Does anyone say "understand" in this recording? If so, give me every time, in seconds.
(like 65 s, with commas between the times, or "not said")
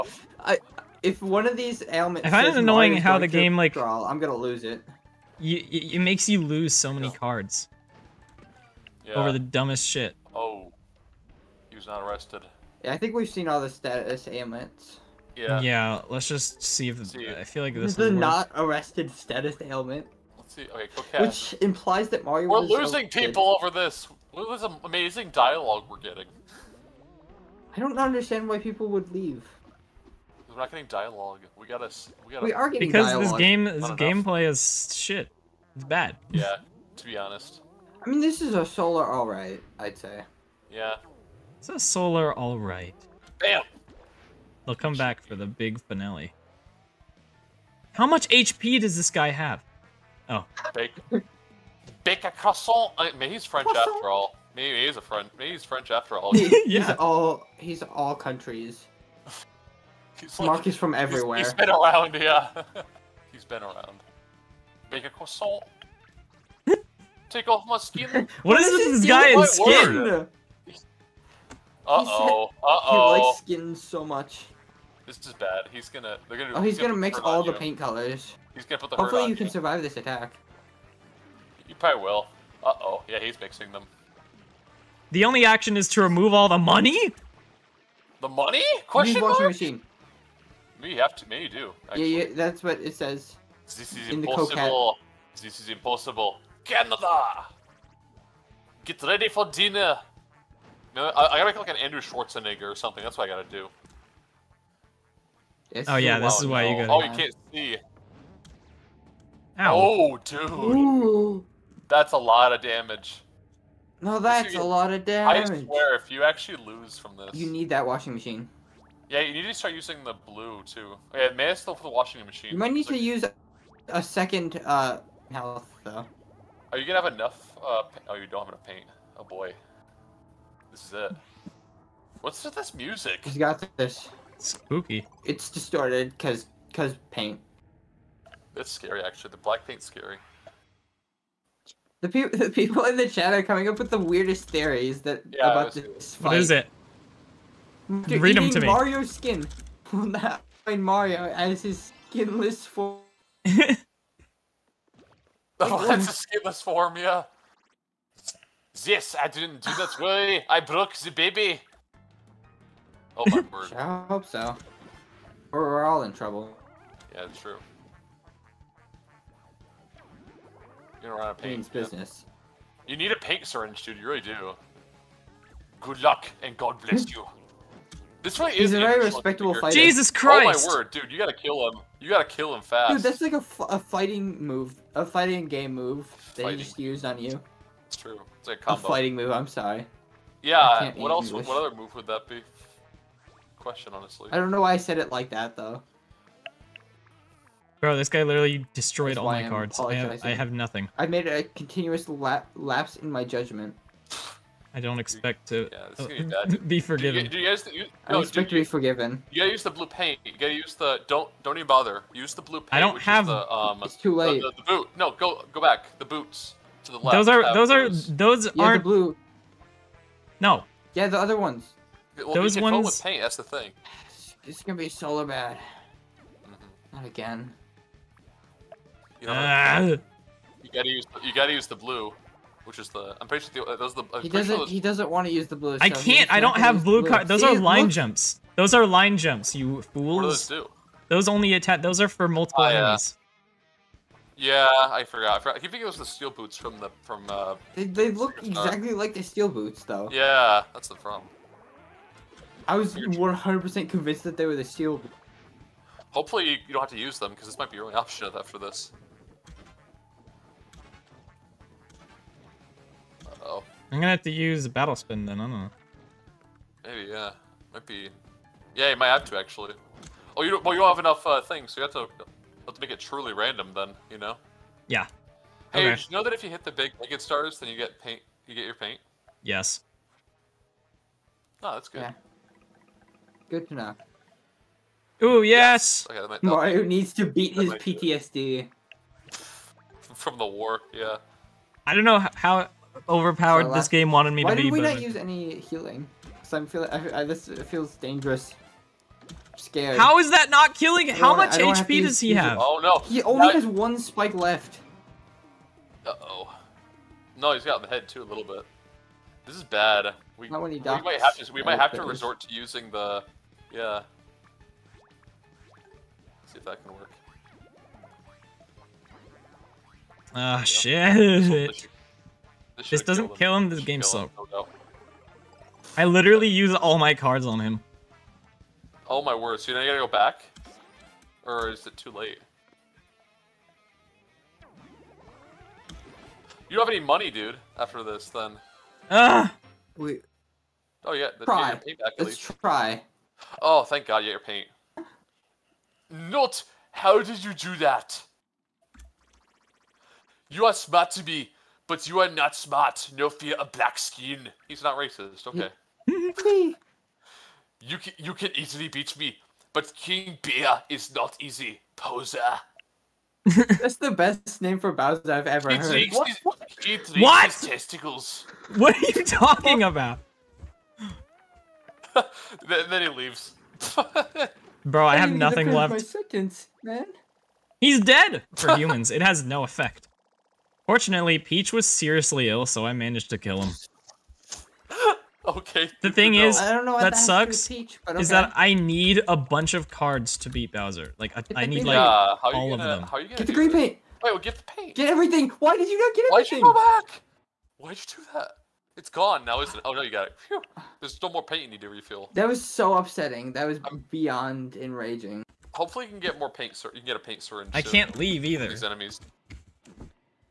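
27 s.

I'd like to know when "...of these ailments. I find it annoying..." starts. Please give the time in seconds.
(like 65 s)
1 s.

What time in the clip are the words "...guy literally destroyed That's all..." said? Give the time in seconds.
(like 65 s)
198 s.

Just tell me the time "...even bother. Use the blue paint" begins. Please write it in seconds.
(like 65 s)
211 s.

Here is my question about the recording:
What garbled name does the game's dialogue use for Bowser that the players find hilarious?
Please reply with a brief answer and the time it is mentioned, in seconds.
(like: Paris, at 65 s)
King Bear, at 359 s.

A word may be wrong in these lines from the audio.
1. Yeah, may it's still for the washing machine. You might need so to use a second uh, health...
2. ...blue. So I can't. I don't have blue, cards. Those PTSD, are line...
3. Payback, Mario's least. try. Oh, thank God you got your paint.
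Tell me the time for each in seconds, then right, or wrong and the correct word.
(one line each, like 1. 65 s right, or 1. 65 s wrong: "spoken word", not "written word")
1. 121 s right
2. 235 s wrong: "See", not "PTSD"
3. 341 s wrong: "Let", not "Mario".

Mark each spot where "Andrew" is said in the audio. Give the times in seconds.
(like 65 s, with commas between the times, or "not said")
101 s.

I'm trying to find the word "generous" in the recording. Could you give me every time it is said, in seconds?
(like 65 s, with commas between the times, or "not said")
not said.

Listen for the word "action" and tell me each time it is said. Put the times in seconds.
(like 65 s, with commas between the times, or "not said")
85 s.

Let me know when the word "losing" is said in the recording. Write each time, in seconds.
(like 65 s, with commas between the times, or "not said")
22 s.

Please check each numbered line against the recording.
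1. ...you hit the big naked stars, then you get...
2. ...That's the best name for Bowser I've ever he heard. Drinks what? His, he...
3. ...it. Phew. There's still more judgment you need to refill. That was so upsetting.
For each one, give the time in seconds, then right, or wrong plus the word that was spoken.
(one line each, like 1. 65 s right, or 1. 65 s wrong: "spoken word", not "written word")
1. 276 s right
2. 363 s right
3. 400 s wrong: "paint", not "judgment".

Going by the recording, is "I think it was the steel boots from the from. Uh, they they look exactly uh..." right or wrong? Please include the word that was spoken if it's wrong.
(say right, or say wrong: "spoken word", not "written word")
right.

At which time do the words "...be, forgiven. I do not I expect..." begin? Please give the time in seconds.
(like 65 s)
206 s.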